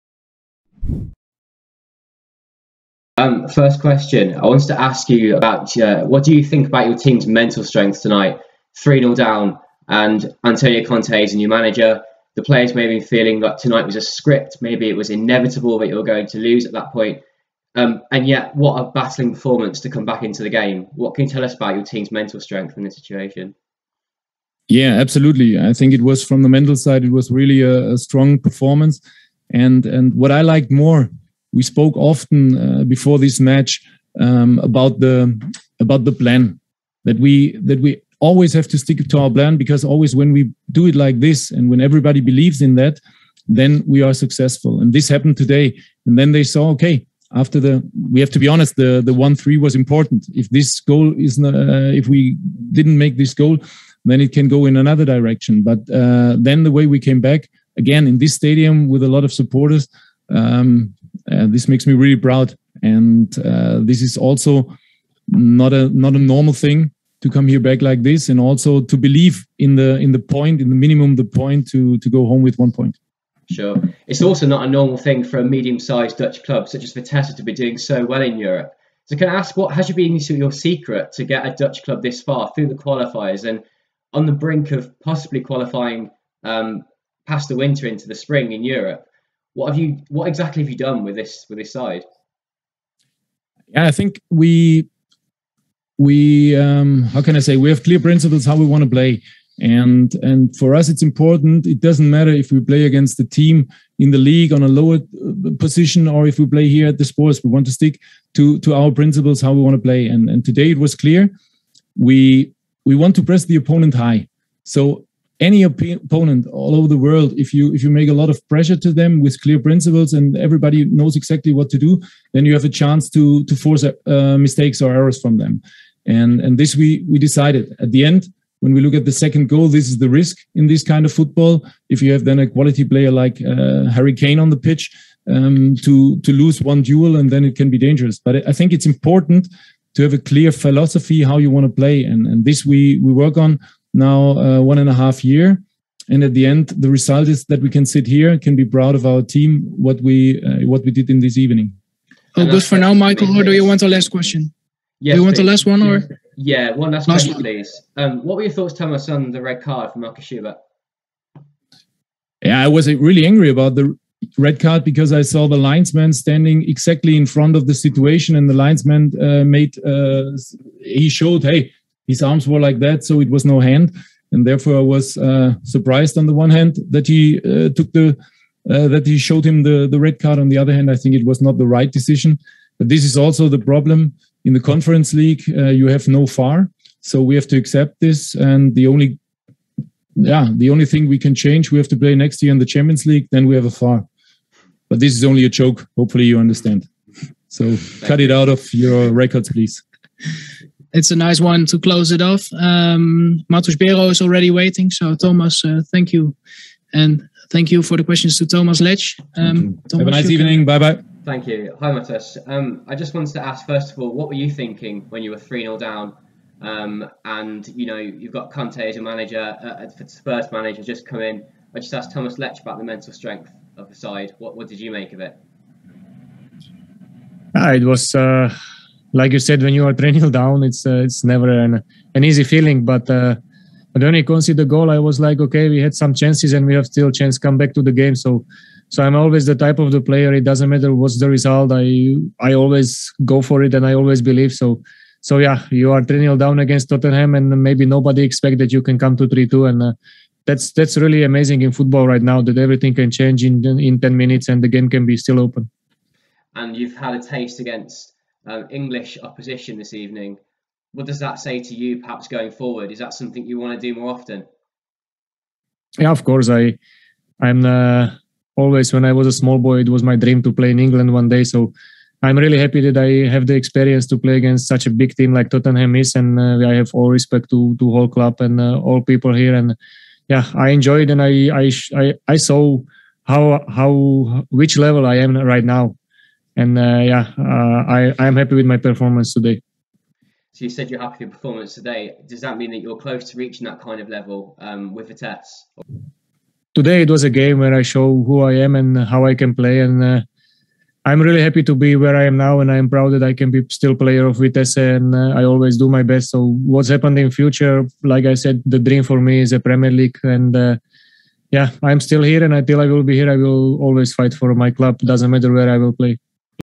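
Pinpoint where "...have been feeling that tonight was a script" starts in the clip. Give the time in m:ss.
0:12.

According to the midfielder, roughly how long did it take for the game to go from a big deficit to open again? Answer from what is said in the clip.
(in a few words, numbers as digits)
10 minutes.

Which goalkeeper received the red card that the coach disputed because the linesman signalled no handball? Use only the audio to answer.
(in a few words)
Markus Schubert.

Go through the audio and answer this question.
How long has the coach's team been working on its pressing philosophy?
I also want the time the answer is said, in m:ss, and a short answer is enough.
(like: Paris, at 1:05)
1.5 years, at 2:24.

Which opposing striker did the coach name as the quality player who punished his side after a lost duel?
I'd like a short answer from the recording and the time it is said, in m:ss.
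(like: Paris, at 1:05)
Harry Kane, at 2:13.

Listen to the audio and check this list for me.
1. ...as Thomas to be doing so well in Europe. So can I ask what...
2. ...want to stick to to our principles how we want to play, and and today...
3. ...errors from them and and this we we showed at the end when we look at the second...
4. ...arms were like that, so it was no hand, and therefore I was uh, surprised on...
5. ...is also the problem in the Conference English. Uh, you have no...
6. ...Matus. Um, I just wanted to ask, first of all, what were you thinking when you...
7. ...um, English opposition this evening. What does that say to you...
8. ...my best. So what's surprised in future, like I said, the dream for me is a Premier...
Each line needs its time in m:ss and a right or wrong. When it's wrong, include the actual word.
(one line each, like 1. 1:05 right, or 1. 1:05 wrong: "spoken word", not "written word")
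1. 1:16 wrong: "Vitesse", not "Thomas"
2. 1:47 right
3. 2:04 wrong: "decided", not "showed"
4. 2:52 right
5. 3:03 wrong: "League", not "English"
6. 3:31 right
7. 4:18 right
8. 5:05 wrong: "happened", not "surprised".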